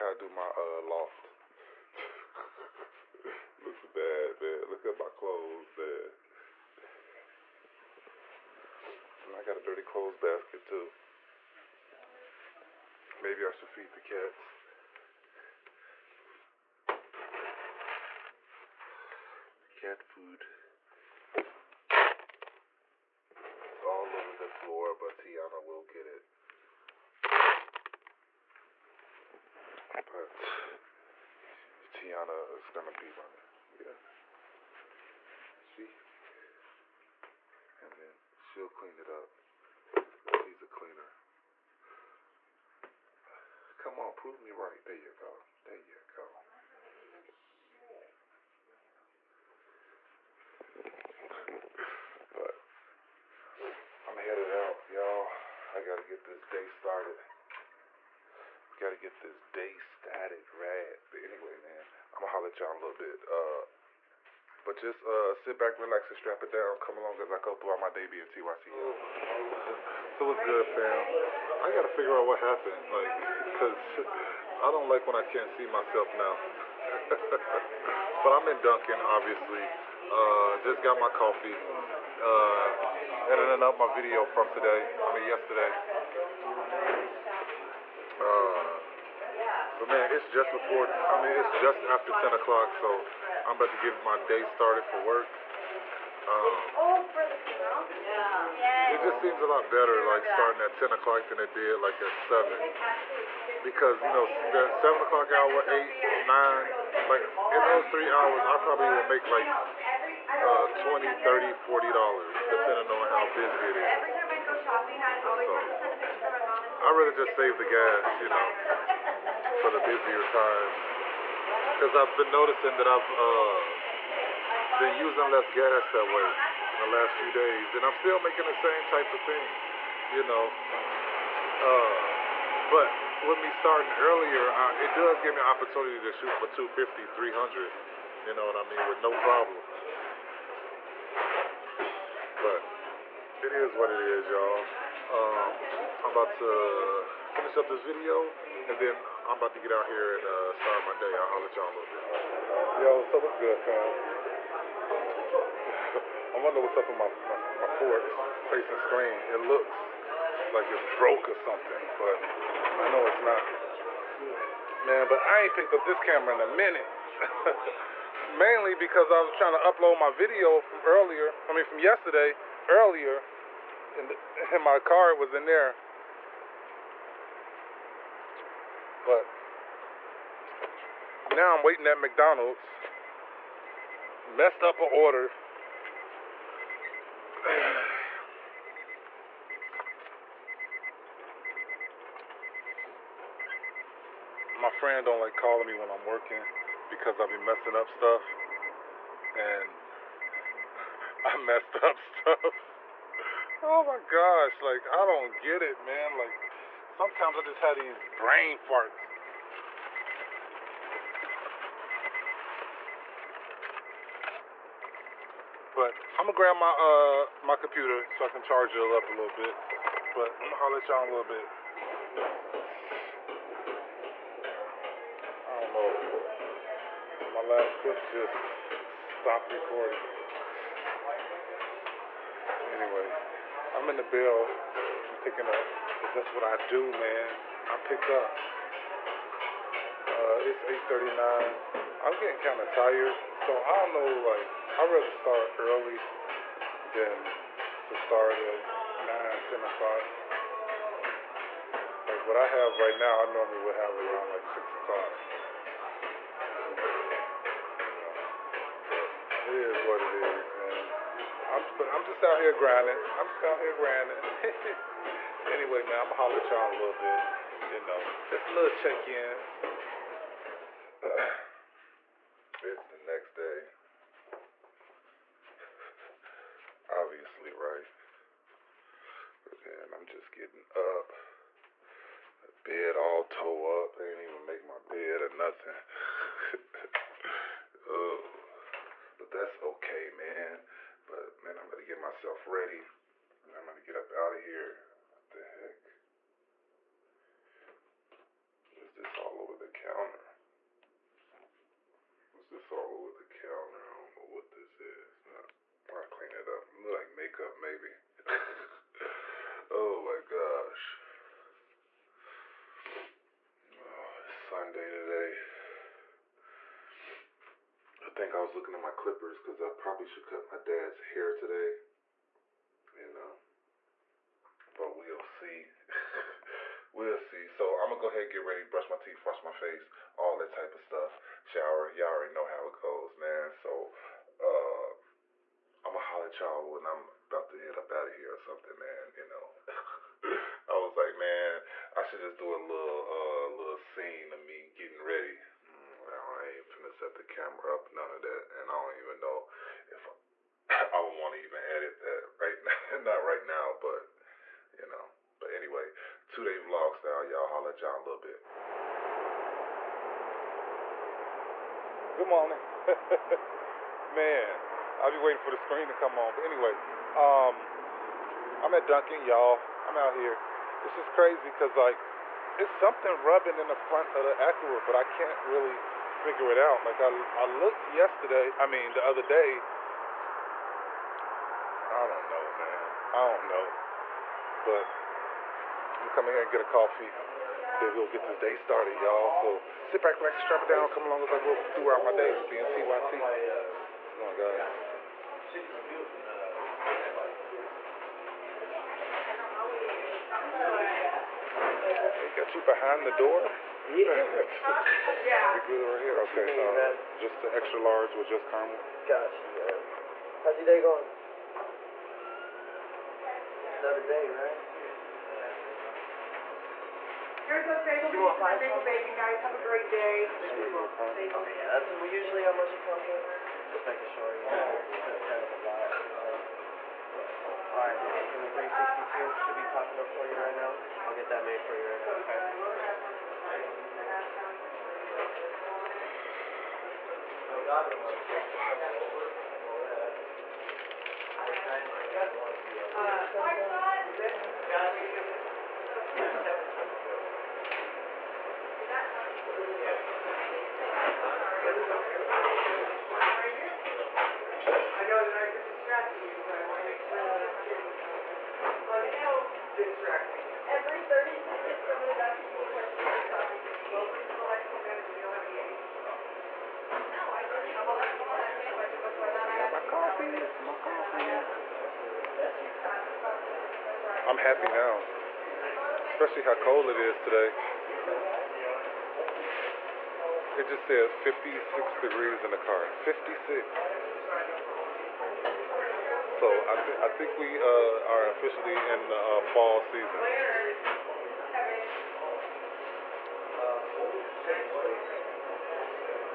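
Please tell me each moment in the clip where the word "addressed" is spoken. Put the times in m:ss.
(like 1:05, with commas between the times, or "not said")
not said.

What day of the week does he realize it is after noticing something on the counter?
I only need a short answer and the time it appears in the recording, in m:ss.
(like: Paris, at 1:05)
Sunday, at 5:14.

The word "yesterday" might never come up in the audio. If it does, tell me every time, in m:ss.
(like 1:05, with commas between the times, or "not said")
1:25, 2:51, 6:17.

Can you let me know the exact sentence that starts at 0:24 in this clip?
floor, but Tiana will get it.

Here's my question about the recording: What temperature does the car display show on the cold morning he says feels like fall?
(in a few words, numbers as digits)
56 degrees.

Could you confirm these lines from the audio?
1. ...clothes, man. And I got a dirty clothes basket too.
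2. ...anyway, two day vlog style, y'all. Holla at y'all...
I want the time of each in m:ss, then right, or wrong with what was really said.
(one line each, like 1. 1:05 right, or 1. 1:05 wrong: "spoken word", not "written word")
1. 0:05 right
2. 5:55 right.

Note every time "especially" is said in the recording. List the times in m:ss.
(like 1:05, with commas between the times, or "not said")
7:56.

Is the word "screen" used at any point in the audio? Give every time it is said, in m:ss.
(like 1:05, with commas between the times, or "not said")
2:38, 6:05.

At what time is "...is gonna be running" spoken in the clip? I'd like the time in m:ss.
0:32.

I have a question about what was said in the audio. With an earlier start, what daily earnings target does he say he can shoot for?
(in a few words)
250 to 300.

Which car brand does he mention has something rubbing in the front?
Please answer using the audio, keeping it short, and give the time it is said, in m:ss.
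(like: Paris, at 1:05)
Acura, at 6:14.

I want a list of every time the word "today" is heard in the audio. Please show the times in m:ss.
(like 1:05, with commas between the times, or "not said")
1:24, 5:14, 5:21, 7:57.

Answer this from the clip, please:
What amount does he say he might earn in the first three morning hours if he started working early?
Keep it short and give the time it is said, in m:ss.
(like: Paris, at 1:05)
$20-40, at 1:50.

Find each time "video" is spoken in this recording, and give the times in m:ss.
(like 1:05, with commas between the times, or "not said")
1:23, 2:27, 2:50.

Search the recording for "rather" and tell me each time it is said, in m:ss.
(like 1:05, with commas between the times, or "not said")
1:56, 4:04.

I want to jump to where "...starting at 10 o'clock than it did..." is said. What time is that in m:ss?
1:40.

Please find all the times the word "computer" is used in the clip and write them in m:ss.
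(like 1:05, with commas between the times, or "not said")
3:37.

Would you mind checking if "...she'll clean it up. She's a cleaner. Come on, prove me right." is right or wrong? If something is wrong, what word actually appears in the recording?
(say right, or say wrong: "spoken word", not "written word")
right.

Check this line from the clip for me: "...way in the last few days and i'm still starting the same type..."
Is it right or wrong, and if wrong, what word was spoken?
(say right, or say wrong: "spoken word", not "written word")
wrong: "making", not "starting".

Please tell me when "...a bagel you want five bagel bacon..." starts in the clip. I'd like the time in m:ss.
6:57.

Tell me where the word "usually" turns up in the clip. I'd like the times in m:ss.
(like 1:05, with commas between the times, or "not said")
7:02.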